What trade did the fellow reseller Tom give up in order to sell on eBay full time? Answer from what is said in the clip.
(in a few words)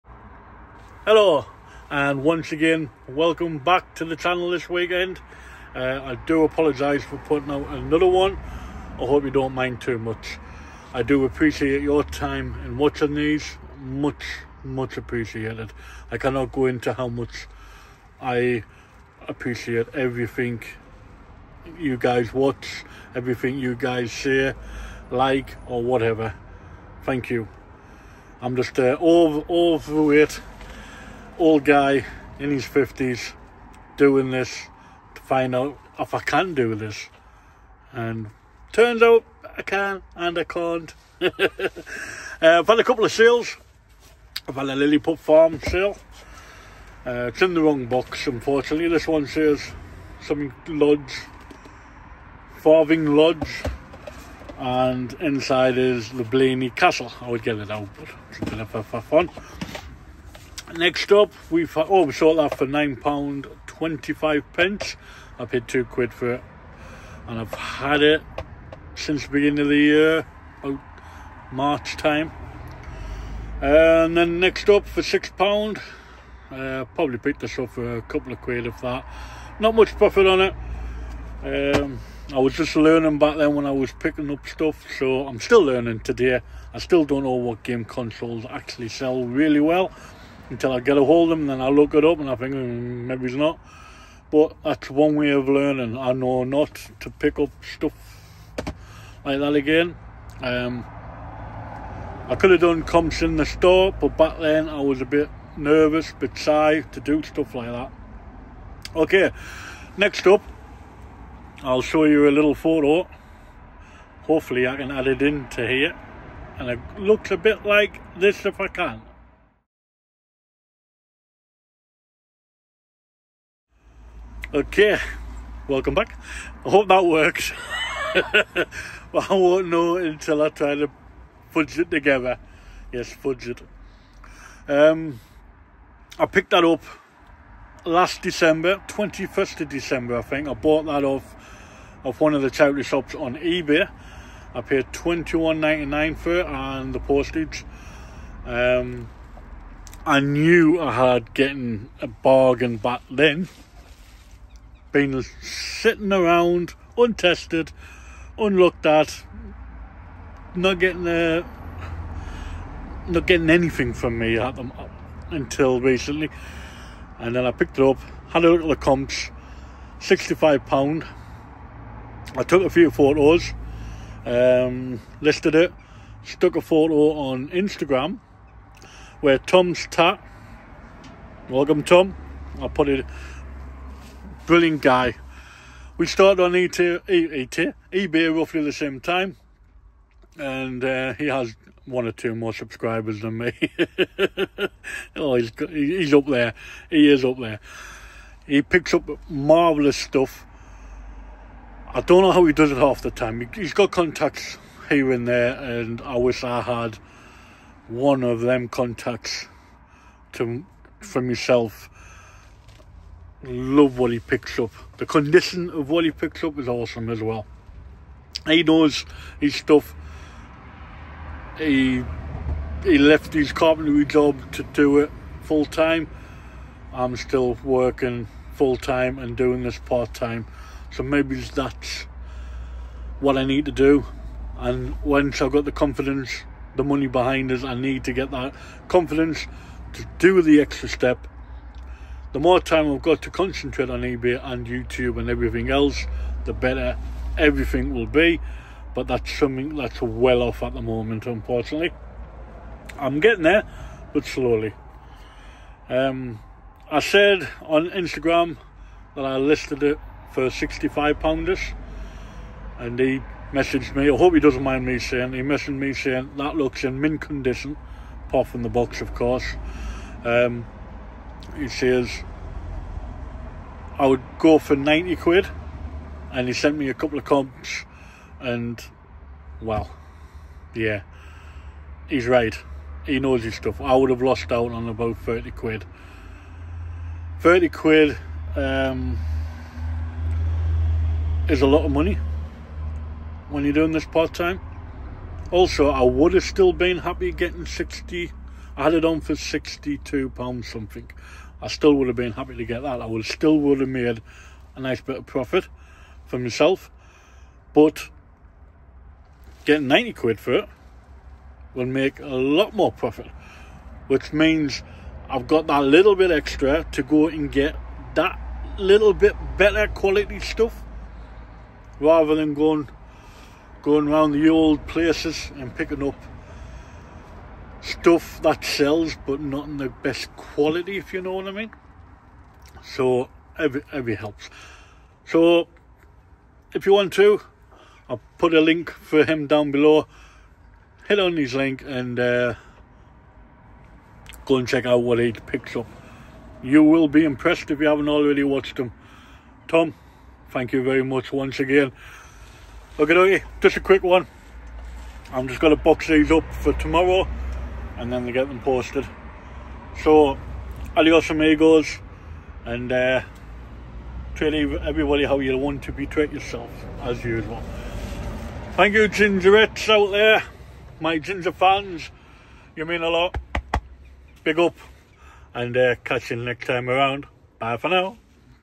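carpentry.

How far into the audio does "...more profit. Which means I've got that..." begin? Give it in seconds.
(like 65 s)
312 s.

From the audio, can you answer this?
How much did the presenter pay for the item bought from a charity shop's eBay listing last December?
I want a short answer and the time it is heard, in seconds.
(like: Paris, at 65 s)
£21.99, at 144 s.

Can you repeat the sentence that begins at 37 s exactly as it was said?
And turns out I can and I can't.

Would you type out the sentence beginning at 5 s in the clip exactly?
Uh, I do apologise for putting out another one.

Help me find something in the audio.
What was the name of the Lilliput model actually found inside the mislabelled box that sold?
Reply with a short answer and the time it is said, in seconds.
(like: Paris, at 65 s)
Blarney Castle, at 56 s.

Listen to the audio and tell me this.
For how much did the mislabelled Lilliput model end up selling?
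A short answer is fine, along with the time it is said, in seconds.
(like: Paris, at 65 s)
£9.25, at 62 s.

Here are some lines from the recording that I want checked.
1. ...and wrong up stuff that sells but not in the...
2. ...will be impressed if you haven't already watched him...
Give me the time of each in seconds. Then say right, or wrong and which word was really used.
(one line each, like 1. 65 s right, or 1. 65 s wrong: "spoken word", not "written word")
1. 325 s wrong: "picking", not "wrong"
2. 346 s right.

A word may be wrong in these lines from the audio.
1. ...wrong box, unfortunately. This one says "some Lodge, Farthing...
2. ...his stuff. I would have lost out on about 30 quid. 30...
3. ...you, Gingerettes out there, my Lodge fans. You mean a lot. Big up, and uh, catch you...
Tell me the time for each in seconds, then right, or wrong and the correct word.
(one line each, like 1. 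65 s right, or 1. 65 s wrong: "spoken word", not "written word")
1. 47 s right
2. 283 s right
3. 368 s wrong: "Ginger", not "Lodge".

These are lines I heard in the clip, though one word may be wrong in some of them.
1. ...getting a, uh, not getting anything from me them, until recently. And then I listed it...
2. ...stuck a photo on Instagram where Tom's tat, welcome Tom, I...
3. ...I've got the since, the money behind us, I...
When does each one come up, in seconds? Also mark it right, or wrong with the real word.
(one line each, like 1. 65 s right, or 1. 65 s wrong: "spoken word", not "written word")
1. 160 s wrong: "picked", not "listed"
2. 176 s right
3. 235 s wrong: "confidence", not "since".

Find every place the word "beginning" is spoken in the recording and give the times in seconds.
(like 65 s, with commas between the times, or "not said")
69 s.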